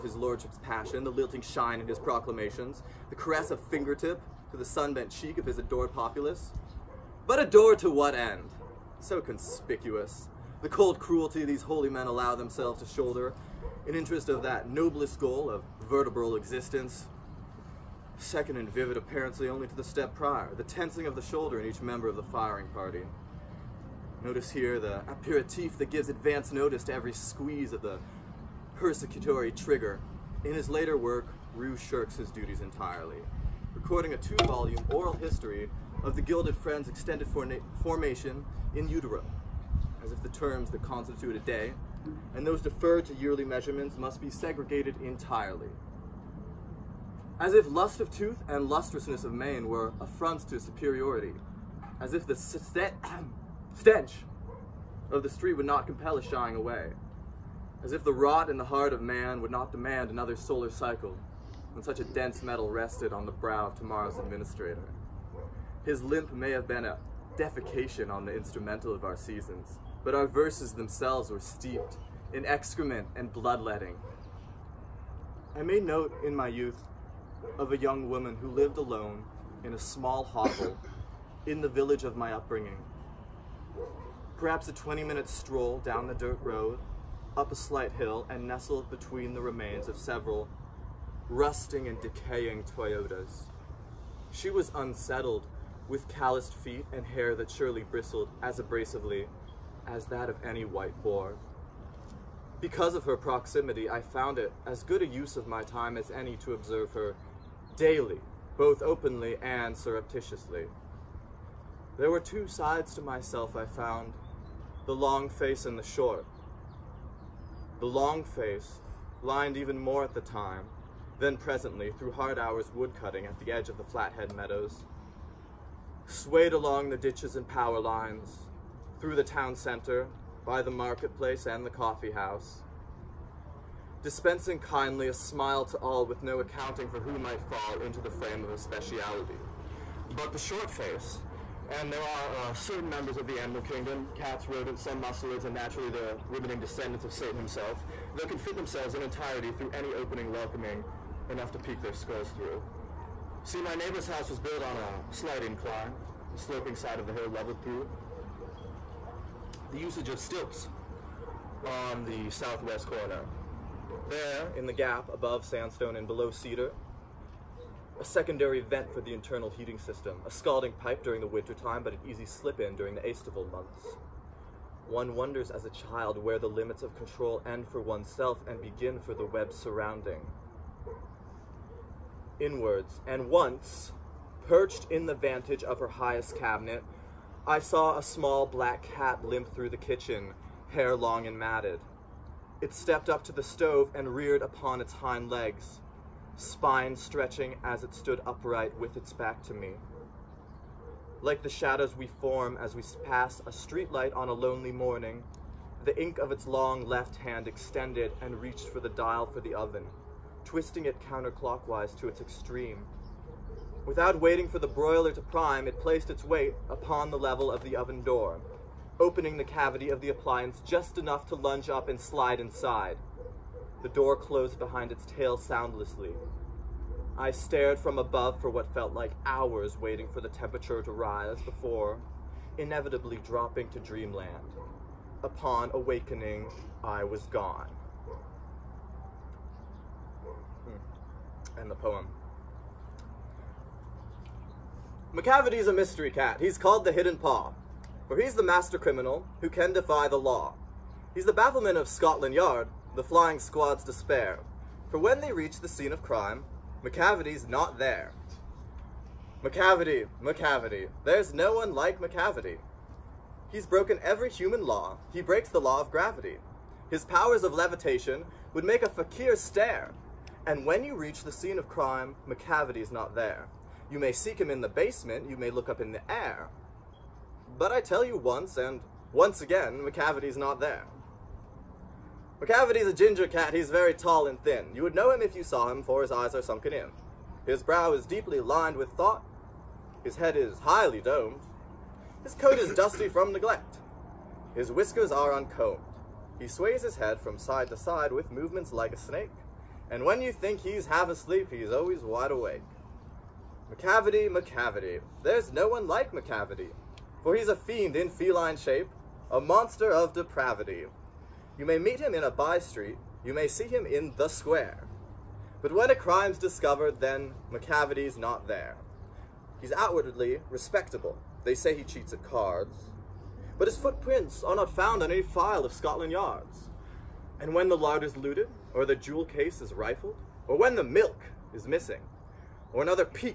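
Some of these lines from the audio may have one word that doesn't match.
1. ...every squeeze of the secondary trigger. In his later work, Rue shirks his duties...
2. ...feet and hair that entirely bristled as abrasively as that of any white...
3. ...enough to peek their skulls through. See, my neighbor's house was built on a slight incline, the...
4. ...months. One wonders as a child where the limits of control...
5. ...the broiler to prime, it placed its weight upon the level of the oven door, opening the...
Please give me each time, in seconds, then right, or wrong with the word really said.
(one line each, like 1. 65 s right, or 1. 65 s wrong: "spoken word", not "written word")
1. 26 s wrong: "persecutory", not "secondary"
2. 96 s wrong: "surely", not "entirely"
3. 151 s right
4. 173 s right
5. 214 s right.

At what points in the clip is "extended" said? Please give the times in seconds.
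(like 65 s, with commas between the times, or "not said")
36 s, 207 s.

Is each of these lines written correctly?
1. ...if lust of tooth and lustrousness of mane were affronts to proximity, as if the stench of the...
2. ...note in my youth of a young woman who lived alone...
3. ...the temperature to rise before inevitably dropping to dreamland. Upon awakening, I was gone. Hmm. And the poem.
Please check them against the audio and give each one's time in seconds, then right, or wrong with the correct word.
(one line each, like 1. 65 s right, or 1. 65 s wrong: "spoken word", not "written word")
1. 47 s wrong: "superiority", not "proximity"
2. 75 s right
3. 230 s right.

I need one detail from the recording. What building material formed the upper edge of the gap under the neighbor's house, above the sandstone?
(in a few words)
cedar.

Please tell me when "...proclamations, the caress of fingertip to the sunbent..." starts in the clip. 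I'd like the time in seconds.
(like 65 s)
1 s.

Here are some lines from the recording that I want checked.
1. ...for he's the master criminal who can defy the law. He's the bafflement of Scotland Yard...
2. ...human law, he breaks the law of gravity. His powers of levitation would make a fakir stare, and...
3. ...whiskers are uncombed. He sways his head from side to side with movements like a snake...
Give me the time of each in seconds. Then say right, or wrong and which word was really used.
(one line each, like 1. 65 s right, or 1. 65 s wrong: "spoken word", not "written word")
1. 248 s right
2. 264 s right
3. 294 s right.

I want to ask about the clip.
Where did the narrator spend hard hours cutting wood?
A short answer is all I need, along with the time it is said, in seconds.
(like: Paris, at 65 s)
Flathead Meadows, at 123 s.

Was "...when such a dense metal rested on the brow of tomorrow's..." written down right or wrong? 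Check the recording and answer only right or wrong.
right.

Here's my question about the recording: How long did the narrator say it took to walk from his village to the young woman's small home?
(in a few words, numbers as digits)
20 minutes.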